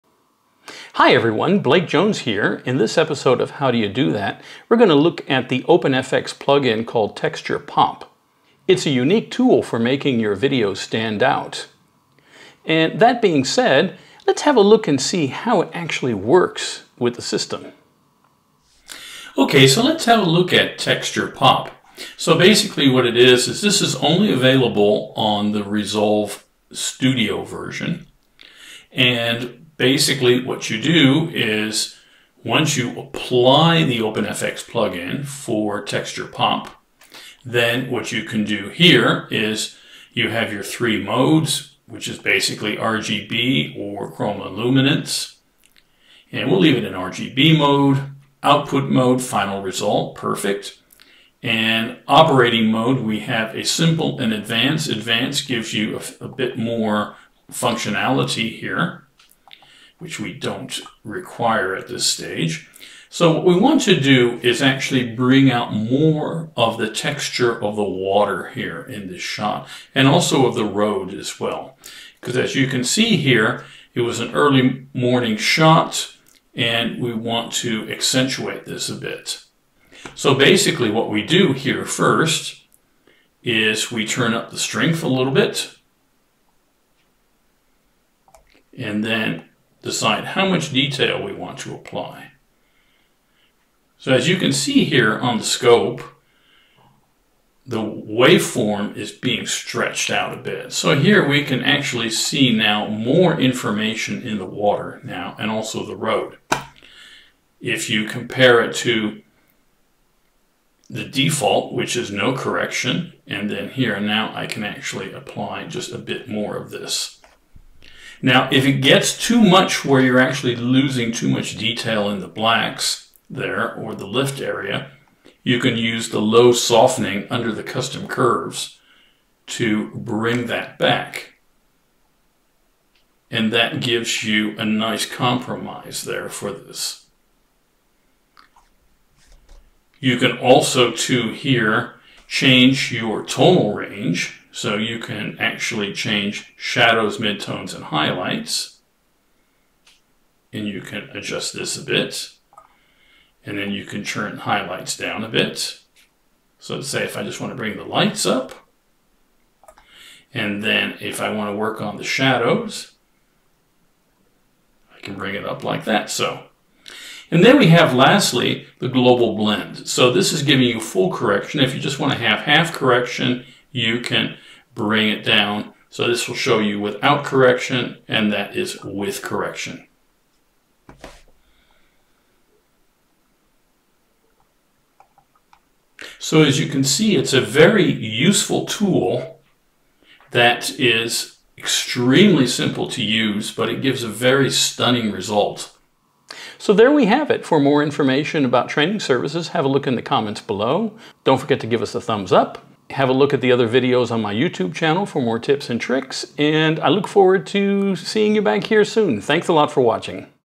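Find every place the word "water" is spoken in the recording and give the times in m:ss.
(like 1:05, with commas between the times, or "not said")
1:07, 1:44.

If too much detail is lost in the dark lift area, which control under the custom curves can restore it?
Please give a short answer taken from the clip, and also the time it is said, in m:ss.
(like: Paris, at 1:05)
Low softening, at 2:06.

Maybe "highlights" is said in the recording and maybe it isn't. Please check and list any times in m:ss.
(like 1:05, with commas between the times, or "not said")
2:27, 2:34.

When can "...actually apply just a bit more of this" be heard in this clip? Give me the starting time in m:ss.
1:54.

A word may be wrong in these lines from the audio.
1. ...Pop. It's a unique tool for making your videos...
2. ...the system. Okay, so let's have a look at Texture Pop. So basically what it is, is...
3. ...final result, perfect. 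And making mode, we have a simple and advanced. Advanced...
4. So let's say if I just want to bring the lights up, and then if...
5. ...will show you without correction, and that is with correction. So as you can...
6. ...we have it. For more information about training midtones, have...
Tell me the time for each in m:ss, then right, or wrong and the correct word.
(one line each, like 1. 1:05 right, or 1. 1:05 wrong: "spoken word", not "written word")
1. 0:07 right
2. 0:17 right
3. 0:49 wrong: "operating", not "making"
4. 2:36 right
5. 2:56 right
6. 3:16 wrong: "services", not "midtones".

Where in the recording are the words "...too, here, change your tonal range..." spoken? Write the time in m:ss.
2:20.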